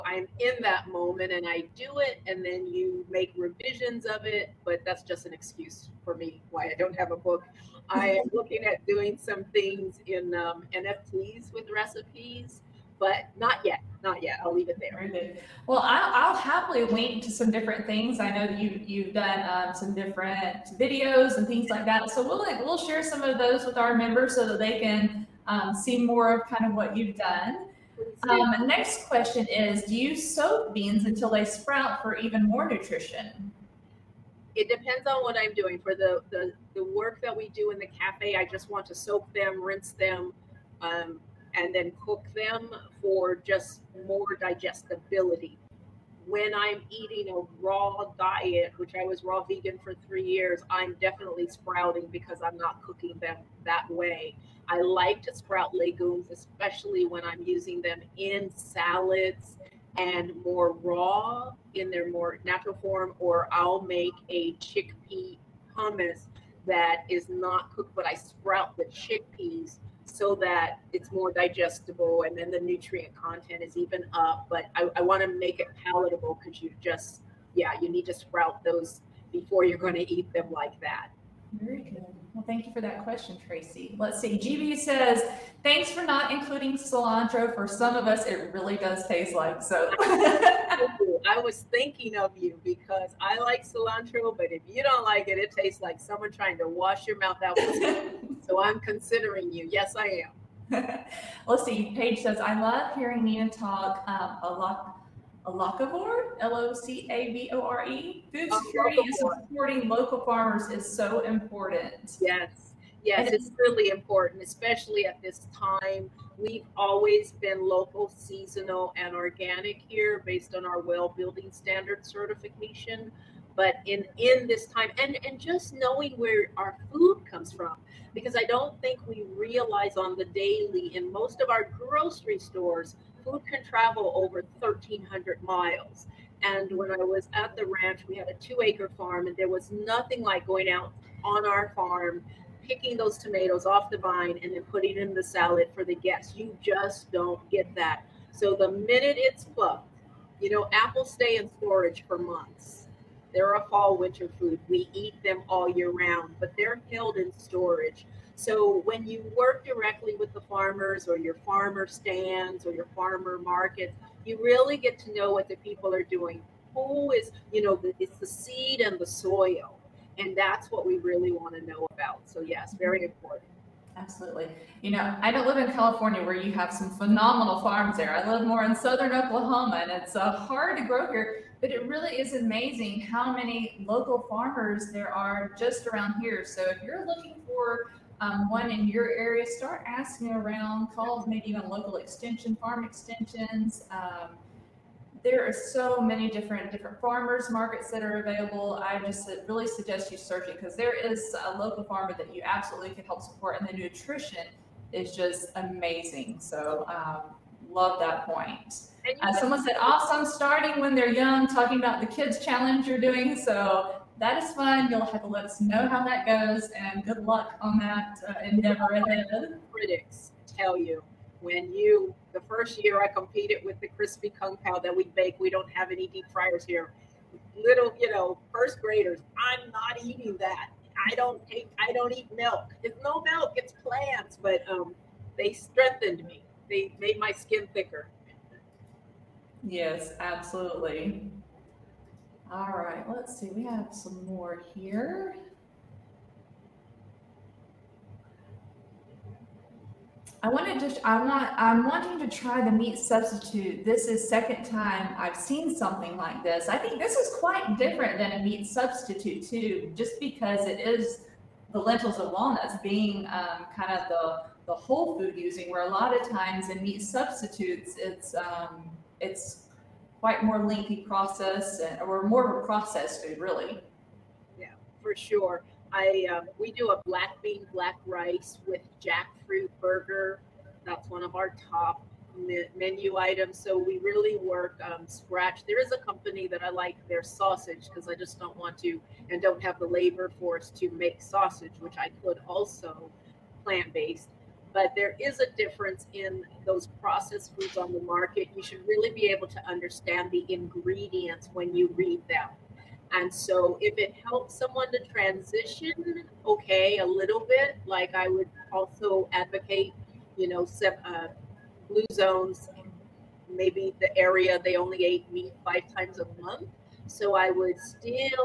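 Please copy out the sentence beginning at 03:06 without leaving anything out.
So if you're looking for um, one in your area, start asking around, call maybe even local extension, farm extensions.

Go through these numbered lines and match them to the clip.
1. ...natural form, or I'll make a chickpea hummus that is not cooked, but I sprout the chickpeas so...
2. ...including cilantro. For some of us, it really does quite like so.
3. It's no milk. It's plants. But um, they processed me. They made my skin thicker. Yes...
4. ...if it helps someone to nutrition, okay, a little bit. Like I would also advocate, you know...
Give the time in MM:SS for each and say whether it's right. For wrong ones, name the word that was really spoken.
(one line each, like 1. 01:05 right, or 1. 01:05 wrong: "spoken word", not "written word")
1. 01:02 right
2. 01:26 wrong: "taste", not "quite"
3. 03:52 wrong: "strengthened", not "processed"
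4. 05:03 wrong: "transition", not "nutrition".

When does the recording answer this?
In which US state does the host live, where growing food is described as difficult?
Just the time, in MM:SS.
02:59.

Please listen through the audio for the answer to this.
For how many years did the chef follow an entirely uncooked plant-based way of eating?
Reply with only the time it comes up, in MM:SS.
00:50.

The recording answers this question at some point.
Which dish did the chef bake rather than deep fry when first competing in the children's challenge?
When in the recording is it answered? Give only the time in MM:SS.
03:43.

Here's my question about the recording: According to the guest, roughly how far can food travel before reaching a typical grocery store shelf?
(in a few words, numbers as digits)
1,300 miles.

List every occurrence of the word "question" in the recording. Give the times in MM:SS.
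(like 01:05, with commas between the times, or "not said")
00:29, 01:23.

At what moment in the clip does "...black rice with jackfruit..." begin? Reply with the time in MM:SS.
04:37.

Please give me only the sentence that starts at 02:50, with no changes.
And that's what we really want to know about.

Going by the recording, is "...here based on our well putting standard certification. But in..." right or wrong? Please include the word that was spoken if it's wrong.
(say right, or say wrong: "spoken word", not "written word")
wrong: "building", not "putting".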